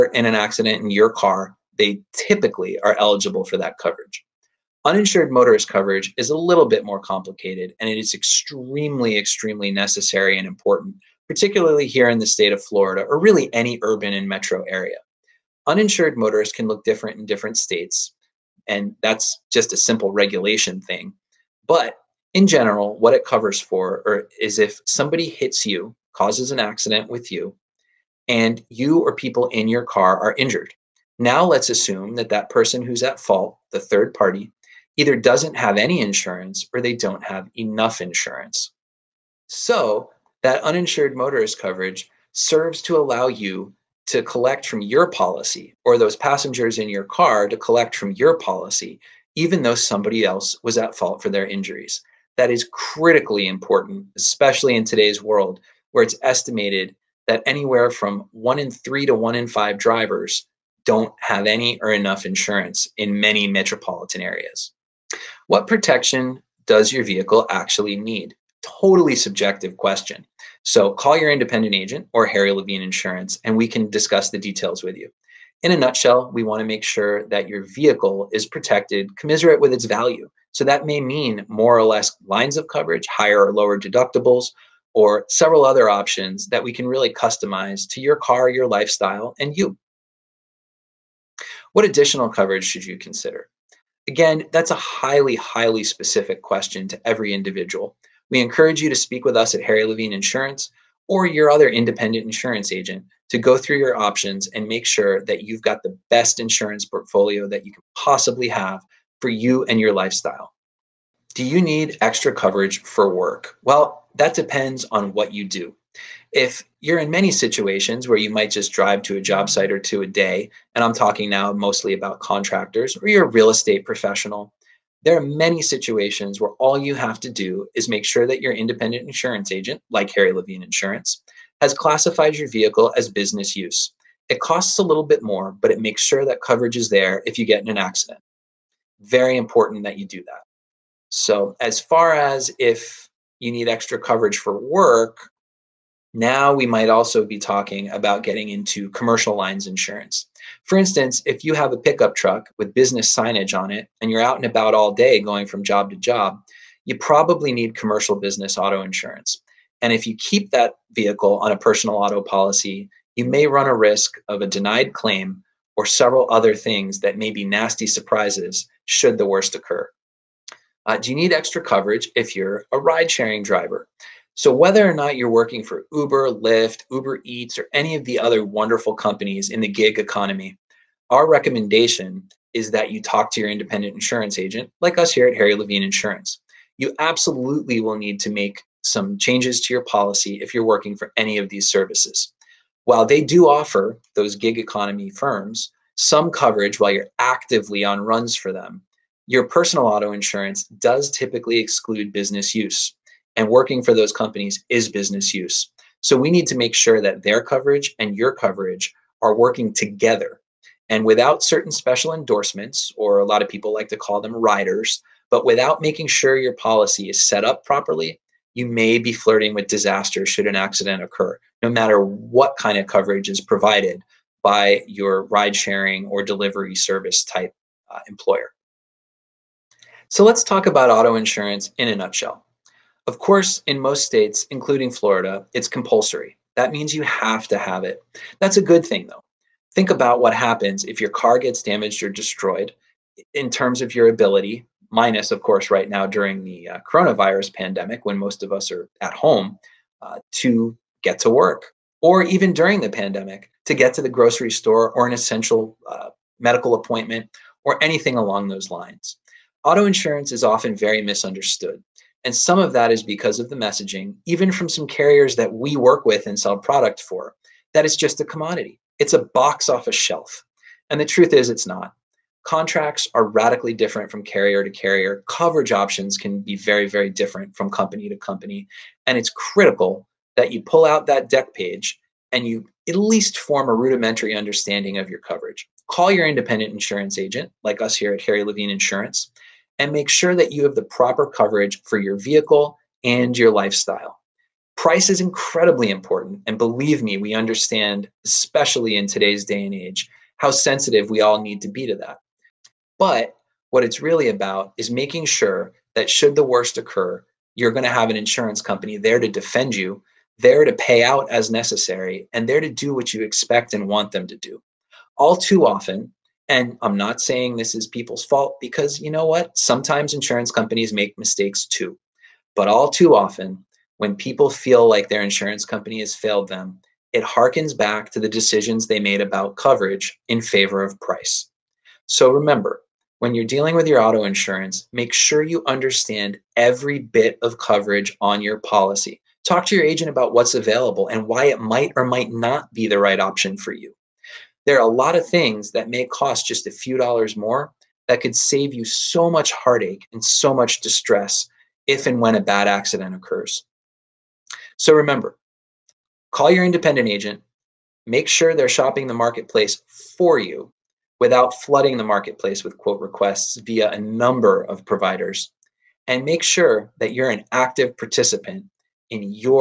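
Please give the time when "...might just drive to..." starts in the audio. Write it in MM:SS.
01:58.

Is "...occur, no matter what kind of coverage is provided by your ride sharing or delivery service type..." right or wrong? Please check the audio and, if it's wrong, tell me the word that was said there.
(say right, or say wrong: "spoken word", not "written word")
right.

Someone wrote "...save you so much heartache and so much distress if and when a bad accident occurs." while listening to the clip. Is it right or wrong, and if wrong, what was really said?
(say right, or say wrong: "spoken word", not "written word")
right.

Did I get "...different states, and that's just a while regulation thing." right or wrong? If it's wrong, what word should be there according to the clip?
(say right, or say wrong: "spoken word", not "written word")
wrong: "simple", not "while".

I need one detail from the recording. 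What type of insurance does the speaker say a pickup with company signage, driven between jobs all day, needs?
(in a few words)
commercial business auto insurance.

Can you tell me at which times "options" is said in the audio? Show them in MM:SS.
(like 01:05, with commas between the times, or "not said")
01:25, 01:43, 04:35, 05:43.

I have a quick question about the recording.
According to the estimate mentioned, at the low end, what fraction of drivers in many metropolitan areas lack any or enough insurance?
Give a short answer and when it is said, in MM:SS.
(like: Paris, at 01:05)
1 in 5, at 00:59.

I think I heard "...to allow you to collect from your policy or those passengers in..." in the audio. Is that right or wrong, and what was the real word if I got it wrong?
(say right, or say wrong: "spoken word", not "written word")
right.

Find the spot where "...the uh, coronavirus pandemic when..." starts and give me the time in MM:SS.
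04:06.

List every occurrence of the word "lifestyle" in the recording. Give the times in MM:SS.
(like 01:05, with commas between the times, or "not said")
01:28, 01:49, 04:53.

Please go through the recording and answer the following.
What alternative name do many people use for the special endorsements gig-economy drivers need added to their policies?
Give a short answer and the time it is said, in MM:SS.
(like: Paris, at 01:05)
riders, at 03:34.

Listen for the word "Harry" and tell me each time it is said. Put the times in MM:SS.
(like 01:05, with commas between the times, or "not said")
01:12, 01:39, 02:10, 03:05, 04:48.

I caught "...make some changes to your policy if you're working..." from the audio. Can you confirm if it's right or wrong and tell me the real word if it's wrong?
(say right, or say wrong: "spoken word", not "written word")
right.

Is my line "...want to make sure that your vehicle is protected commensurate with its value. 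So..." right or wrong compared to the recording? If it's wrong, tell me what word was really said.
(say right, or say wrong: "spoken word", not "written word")
right.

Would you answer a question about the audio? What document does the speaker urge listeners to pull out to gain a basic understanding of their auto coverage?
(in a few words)
dec page.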